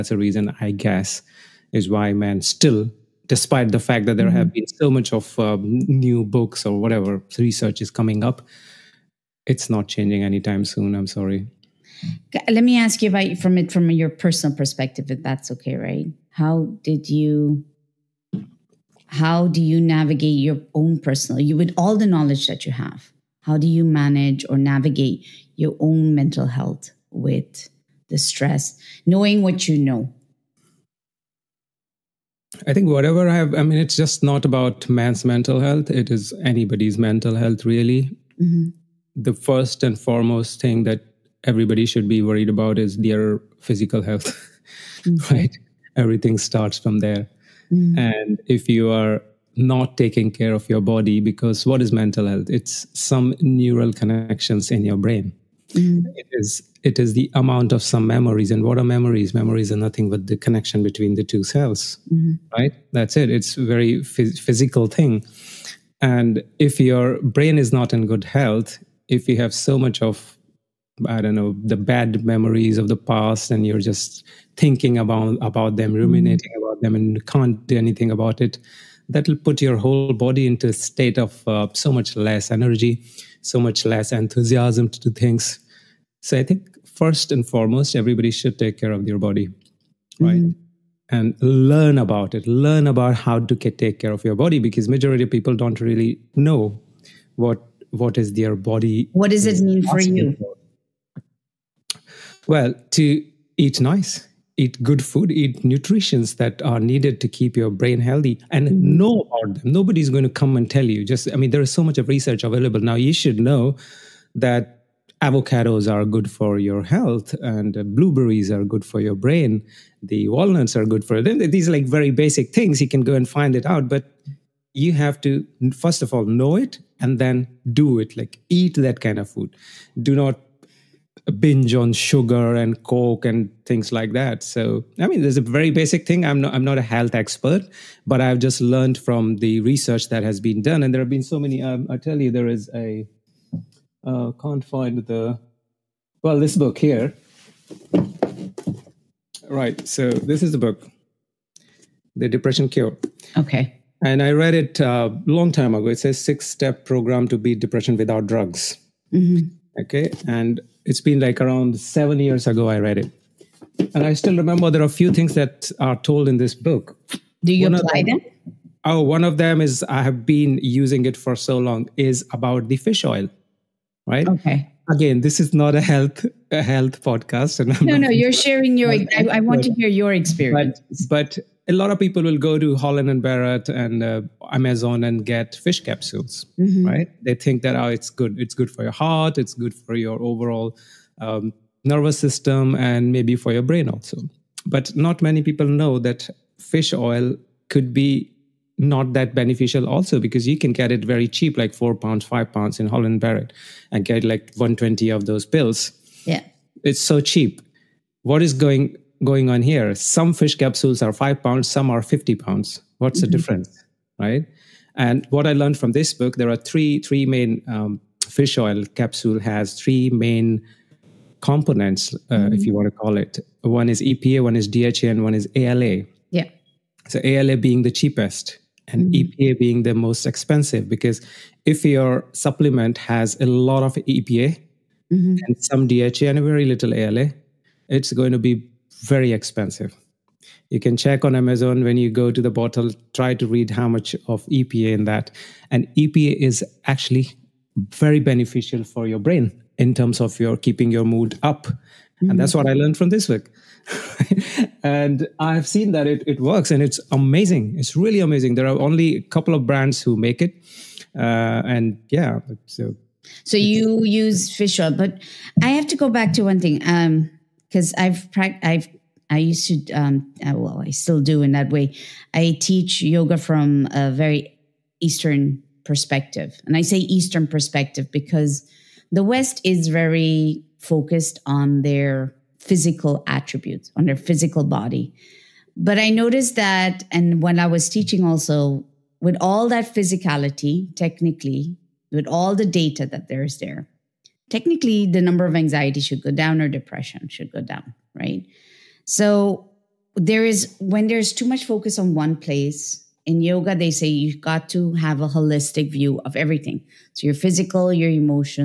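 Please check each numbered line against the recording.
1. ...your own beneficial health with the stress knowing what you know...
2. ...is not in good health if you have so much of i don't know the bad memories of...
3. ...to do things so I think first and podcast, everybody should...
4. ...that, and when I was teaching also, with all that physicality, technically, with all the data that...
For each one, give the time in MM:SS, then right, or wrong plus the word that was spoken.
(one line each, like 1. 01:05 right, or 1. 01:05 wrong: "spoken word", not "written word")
1. 00:25 wrong: "mental", not "beneficial"
2. 01:07 right
3. 01:24 wrong: "foremost", not "podcast"
4. 04:46 right.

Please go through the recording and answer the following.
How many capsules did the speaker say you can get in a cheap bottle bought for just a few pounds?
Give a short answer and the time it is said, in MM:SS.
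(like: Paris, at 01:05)
120, at 03:24.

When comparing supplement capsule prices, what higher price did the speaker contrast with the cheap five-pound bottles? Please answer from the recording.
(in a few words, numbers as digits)
50 pounds.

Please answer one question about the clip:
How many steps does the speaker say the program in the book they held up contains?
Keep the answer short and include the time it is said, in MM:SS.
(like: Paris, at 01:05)
6, at 02:36.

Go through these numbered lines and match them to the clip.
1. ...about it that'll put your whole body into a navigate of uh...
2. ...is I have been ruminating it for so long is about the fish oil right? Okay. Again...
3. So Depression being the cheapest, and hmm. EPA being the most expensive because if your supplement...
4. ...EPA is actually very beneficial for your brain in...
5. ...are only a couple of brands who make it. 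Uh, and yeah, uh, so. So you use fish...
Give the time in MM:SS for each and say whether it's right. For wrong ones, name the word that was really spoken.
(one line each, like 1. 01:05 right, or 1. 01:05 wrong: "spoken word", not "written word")
1. 01:18 wrong: "state", not "navigate"
2. 02:49 wrong: "using", not "ruminating"
3. 03:47 wrong: "ALA", not "Depression"
4. 04:05 right
5. 04:18 right.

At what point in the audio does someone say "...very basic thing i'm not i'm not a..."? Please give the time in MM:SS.
02:15.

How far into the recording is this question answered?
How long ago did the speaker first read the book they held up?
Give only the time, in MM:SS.
02:41.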